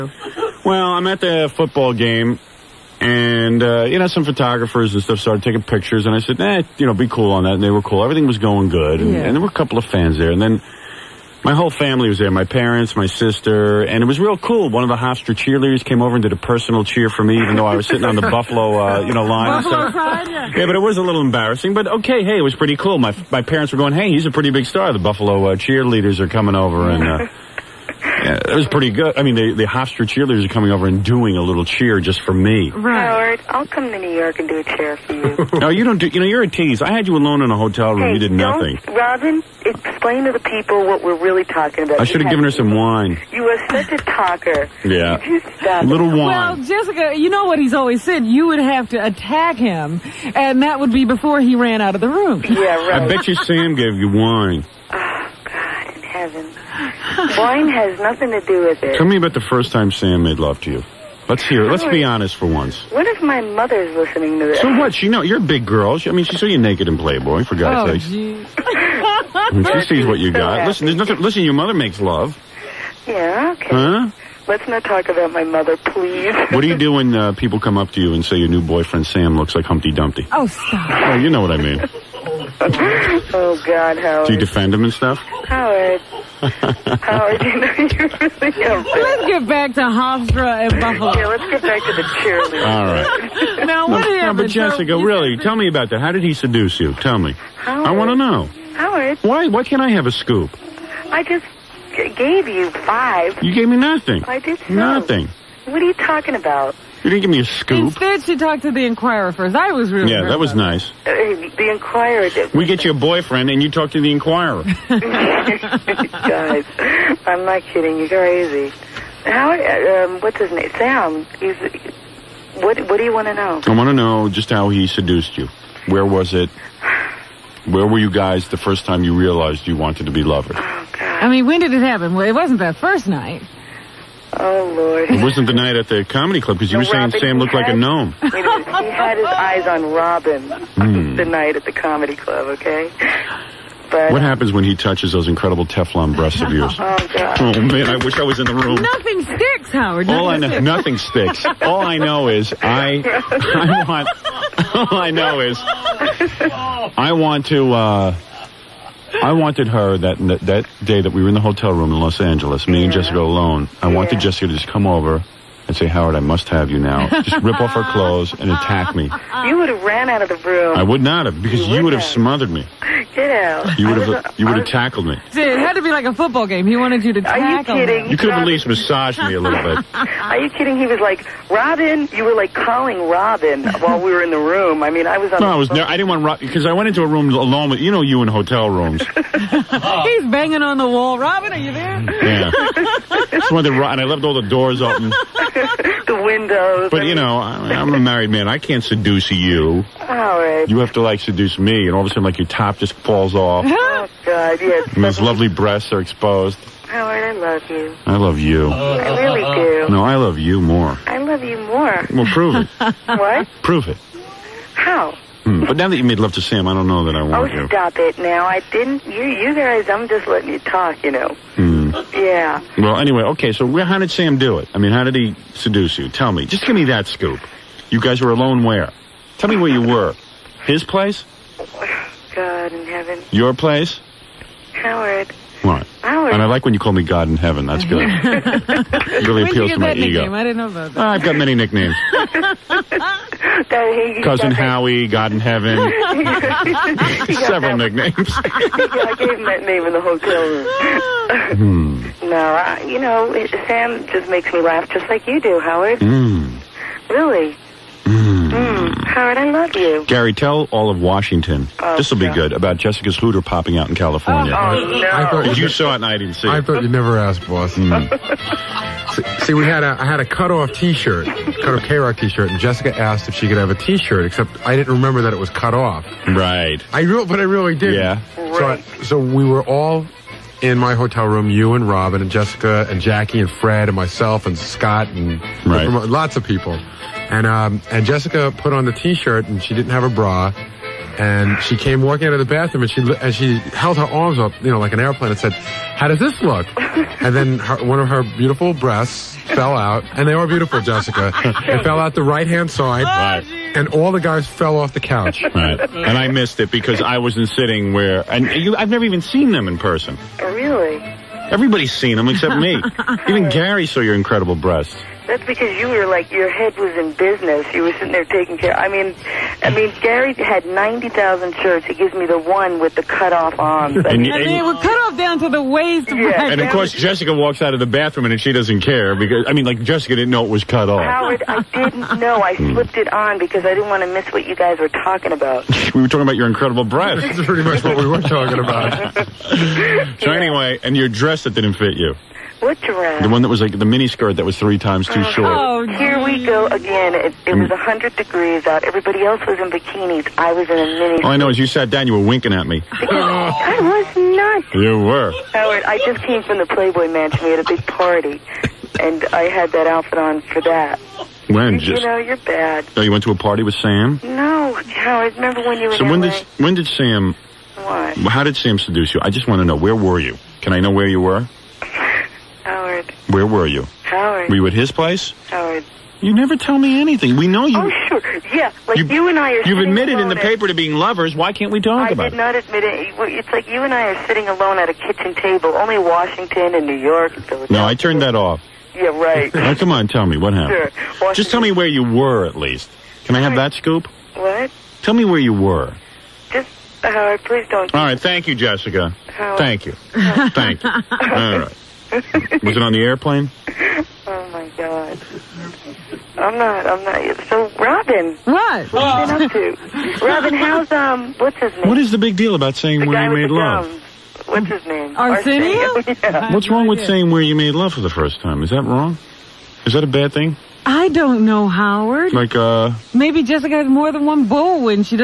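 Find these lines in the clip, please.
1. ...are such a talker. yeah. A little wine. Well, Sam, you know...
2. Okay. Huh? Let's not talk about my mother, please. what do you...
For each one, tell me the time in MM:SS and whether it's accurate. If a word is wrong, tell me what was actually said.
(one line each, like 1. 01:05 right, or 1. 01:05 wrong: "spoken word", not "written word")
1. 00:43 wrong: "Jessica", not "Sam"
2. 01:13 right.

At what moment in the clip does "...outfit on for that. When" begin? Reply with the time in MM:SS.
05:59.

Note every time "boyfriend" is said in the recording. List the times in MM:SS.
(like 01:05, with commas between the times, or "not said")
01:18, 01:52.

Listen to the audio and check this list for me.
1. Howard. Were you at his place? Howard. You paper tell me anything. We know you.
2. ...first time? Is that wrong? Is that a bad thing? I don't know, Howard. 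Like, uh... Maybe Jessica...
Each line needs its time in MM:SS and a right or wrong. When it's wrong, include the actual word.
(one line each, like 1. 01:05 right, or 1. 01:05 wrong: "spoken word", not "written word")
1. 06:14 wrong: "never", not "paper"
2. 06:58 right.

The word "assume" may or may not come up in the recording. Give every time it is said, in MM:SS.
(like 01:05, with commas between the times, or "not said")
not said.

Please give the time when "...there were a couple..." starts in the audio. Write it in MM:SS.
00:09.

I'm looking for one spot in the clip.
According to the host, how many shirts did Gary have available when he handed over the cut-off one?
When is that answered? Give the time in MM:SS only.
05:20.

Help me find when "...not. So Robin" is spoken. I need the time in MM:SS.
06:47.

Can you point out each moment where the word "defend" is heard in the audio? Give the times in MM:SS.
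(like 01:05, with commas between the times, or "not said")
01:24.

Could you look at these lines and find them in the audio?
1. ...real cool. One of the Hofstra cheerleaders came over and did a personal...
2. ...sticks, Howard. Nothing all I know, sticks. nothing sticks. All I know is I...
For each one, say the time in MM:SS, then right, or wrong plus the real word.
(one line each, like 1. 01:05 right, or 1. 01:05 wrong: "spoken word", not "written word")
1. 00:14 right
2. 02:29 right.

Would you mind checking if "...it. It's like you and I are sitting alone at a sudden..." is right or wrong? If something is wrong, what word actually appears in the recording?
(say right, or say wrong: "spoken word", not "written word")
wrong: "kitchen", not "sudden".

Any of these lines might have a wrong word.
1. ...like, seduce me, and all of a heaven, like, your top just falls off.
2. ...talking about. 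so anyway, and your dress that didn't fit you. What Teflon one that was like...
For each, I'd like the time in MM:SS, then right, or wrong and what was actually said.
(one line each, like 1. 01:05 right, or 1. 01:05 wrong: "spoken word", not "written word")
1. 03:21 wrong: "sudden", not "heaven"
2. 05:38 wrong: "The", not "Teflon".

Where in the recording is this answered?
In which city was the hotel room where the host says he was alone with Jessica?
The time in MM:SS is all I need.
02:41.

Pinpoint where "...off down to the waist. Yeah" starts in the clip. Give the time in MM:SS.
05:25.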